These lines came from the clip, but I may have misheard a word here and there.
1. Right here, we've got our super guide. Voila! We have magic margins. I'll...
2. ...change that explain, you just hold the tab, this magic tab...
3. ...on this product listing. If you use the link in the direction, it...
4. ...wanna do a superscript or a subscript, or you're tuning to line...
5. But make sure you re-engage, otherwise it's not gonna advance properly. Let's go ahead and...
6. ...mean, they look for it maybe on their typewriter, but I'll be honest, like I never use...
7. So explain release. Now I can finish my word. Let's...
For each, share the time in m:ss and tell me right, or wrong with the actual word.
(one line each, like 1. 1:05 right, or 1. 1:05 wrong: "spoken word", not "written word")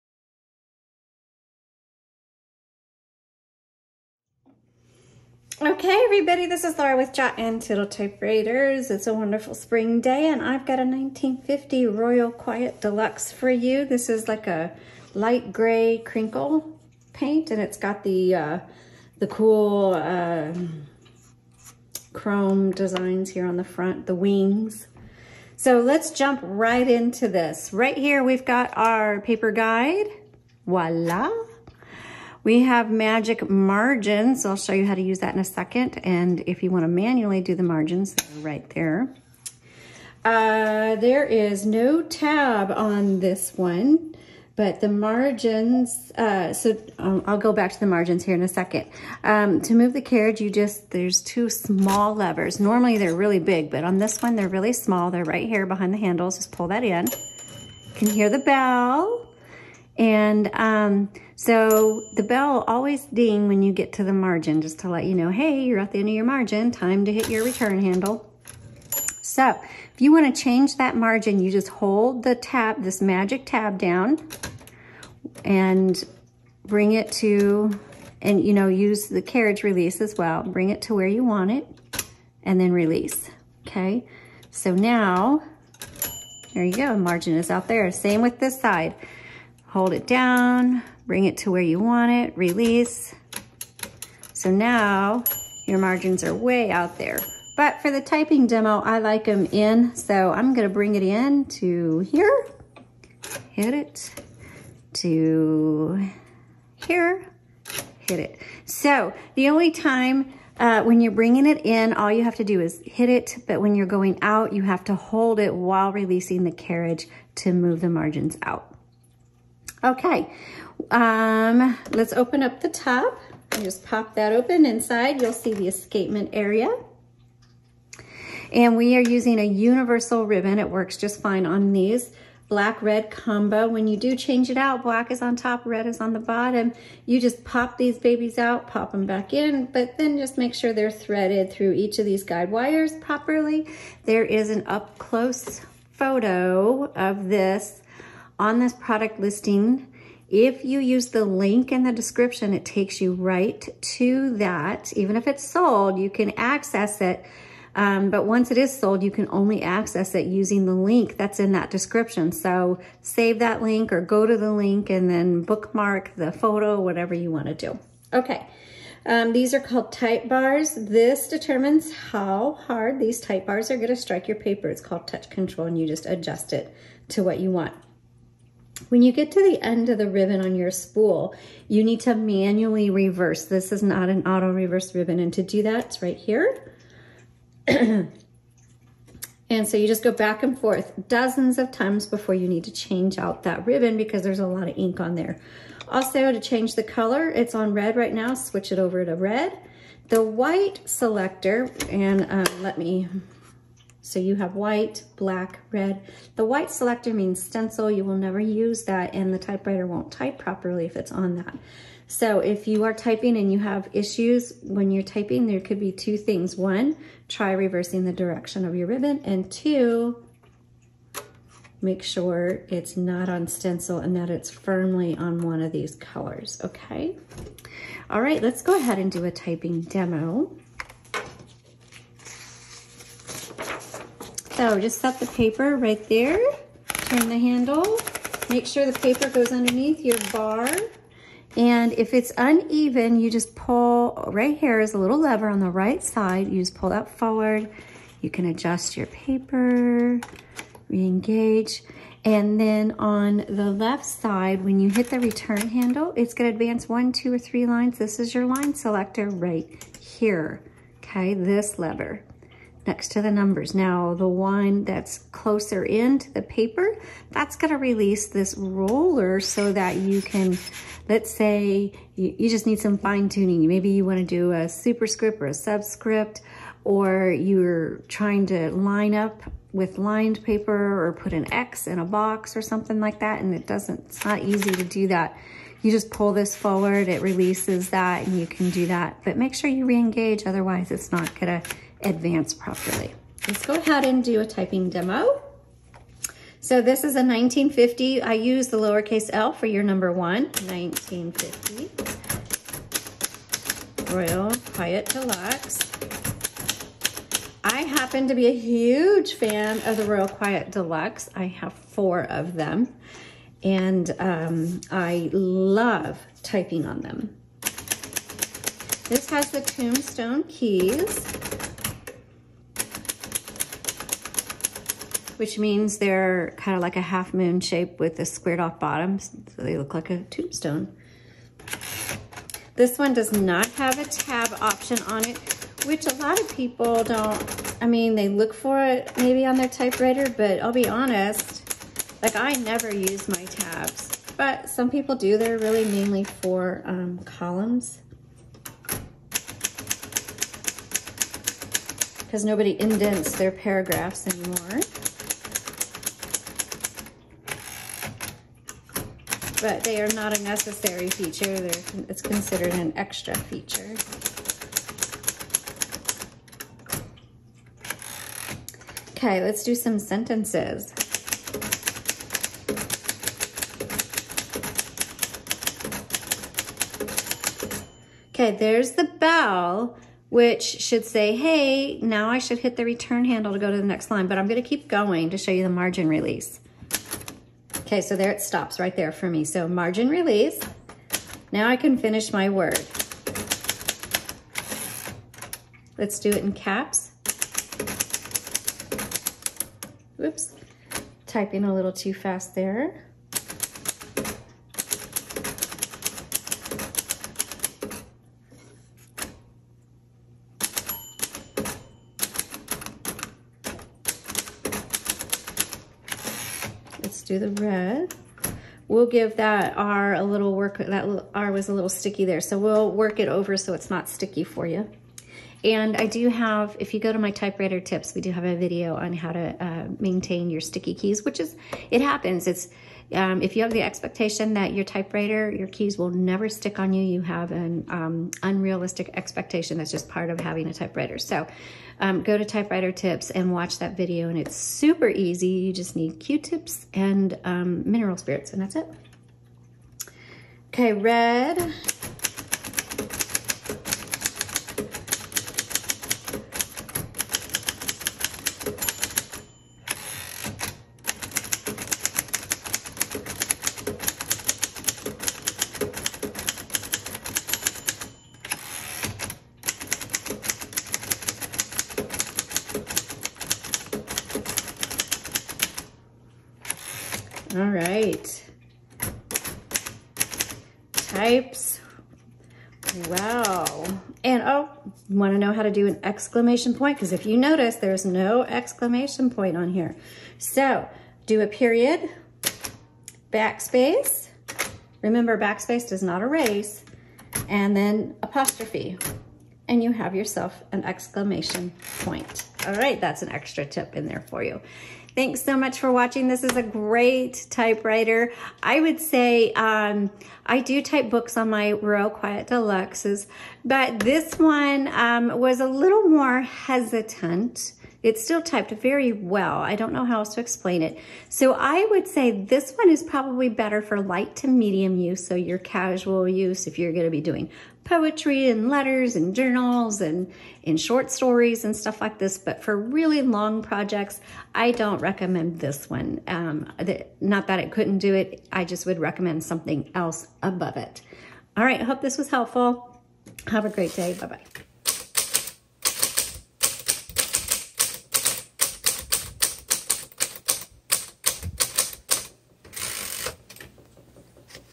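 1. 0:27 wrong: "paper", not "super"
2. 1:10 wrong: "margin", not "explain"
3. 2:28 wrong: "description", not "direction"
4. 4:34 wrong: "trying", not "tuning"
5. 4:49 right
6. 5:37 right
7. 6:29 wrong: "margin", not "explain".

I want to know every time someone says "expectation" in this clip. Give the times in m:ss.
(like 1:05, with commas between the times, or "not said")
7:13, 7:19.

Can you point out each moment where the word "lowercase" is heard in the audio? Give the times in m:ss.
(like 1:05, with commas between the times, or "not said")
4:58.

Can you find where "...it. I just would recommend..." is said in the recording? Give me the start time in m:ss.
8:58.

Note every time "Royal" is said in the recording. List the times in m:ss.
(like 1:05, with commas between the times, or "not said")
0:11, 5:04, 5:10, 8:31.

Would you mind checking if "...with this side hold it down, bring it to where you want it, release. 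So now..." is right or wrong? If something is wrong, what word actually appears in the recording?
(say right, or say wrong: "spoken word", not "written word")
right.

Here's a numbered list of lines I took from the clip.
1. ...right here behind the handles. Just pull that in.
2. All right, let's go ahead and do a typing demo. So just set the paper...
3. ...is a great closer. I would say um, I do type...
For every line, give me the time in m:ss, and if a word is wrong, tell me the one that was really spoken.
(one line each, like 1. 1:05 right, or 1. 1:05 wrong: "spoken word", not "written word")
1. 0:55 right
2. 3:48 right
3. 8:26 wrong: "typewriter", not "closer".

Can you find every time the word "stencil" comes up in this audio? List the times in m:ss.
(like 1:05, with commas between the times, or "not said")
3:27, 3:43.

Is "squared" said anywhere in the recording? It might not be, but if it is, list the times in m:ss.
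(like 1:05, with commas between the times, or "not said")
5:28.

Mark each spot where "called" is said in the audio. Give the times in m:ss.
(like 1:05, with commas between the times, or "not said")
2:49, 2:54.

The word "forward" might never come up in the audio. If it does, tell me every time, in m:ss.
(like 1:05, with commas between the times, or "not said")
4:07, 4:46.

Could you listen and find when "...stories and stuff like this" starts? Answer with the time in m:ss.
8:51.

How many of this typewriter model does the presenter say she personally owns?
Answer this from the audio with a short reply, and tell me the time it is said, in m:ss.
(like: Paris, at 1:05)
4, at 5:11.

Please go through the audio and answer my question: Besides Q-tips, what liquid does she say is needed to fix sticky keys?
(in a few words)
Mineral spirits.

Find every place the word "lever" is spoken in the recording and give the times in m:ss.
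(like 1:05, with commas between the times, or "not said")
0:52, 4:05, 4:21.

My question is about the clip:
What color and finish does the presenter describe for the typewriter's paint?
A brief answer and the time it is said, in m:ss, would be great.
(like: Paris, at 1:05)
Light gray crinkle, at 0:15.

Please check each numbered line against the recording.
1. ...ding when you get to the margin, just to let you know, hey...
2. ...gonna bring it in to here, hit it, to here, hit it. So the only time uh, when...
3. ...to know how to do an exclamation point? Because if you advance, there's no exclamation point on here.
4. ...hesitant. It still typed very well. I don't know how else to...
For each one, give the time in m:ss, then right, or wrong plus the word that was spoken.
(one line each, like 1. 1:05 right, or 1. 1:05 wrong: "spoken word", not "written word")
1. 1:03 right
2. 1:40 right
3. 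8:05 wrong: "notice", not "advance"
4. 8:36 right.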